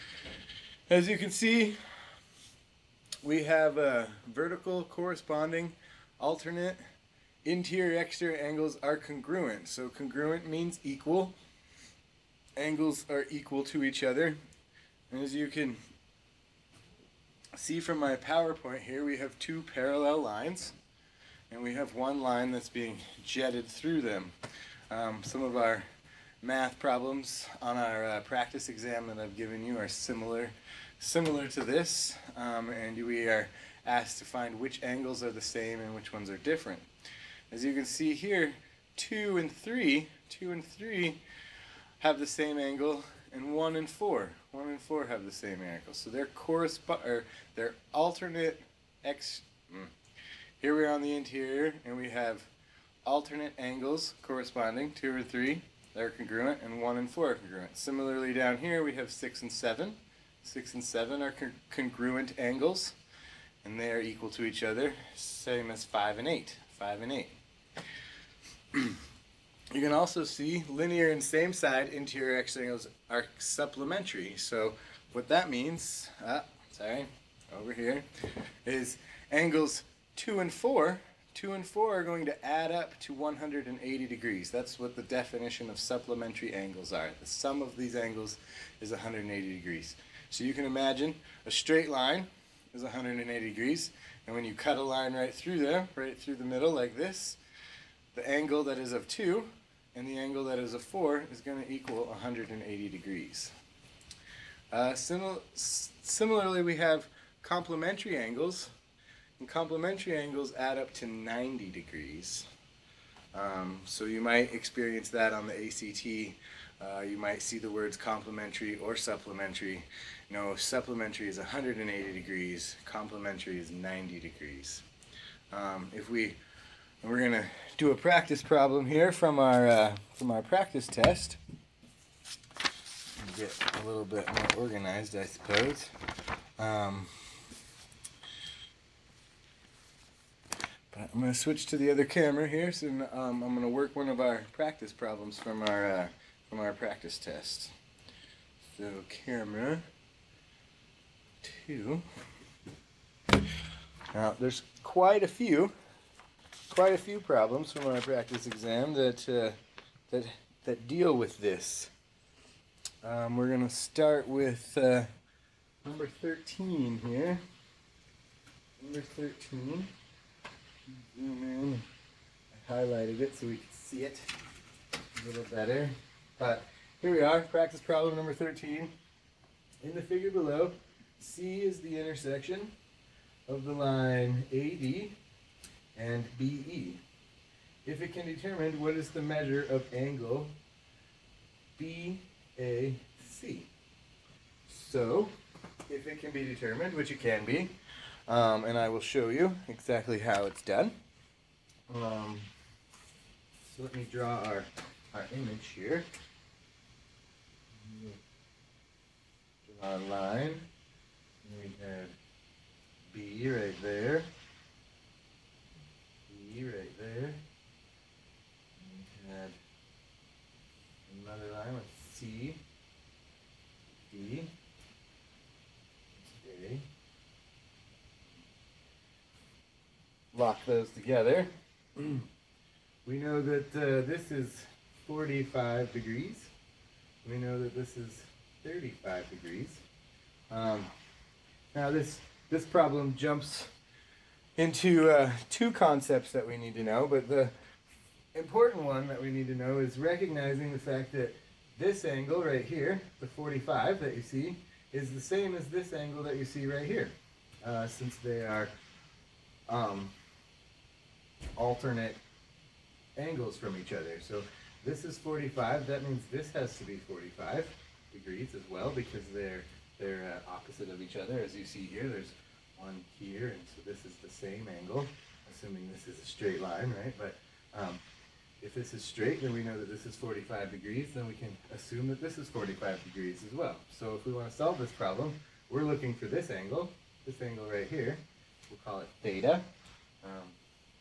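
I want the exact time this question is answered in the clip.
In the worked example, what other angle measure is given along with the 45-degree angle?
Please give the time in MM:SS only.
03:58.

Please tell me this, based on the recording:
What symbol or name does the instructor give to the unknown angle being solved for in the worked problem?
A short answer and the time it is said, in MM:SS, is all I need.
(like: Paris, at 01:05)
theta, at 04:49.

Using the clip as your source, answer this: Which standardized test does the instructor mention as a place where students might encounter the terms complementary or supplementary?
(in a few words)
ACT.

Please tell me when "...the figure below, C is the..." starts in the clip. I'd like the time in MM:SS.
02:59.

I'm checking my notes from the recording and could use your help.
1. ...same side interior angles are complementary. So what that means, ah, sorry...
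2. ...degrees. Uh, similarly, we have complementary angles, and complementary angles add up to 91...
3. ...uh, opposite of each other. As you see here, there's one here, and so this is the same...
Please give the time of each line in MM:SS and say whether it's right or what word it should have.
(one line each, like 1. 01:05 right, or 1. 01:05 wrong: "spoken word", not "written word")
1. 01:11 wrong: "supplementary", not "complementary"
2. 01:42 wrong: "90", not "91"
3. 04:30 right.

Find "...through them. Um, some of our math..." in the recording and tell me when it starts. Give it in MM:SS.
00:23.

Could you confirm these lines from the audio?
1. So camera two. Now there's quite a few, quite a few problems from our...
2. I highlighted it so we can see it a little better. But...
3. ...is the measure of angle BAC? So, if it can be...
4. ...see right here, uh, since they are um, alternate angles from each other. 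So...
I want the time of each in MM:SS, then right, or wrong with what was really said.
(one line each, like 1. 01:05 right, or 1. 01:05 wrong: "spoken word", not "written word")
1. 02:28 right
2. 02:52 right
3. 03:08 right
4. 04:16 right.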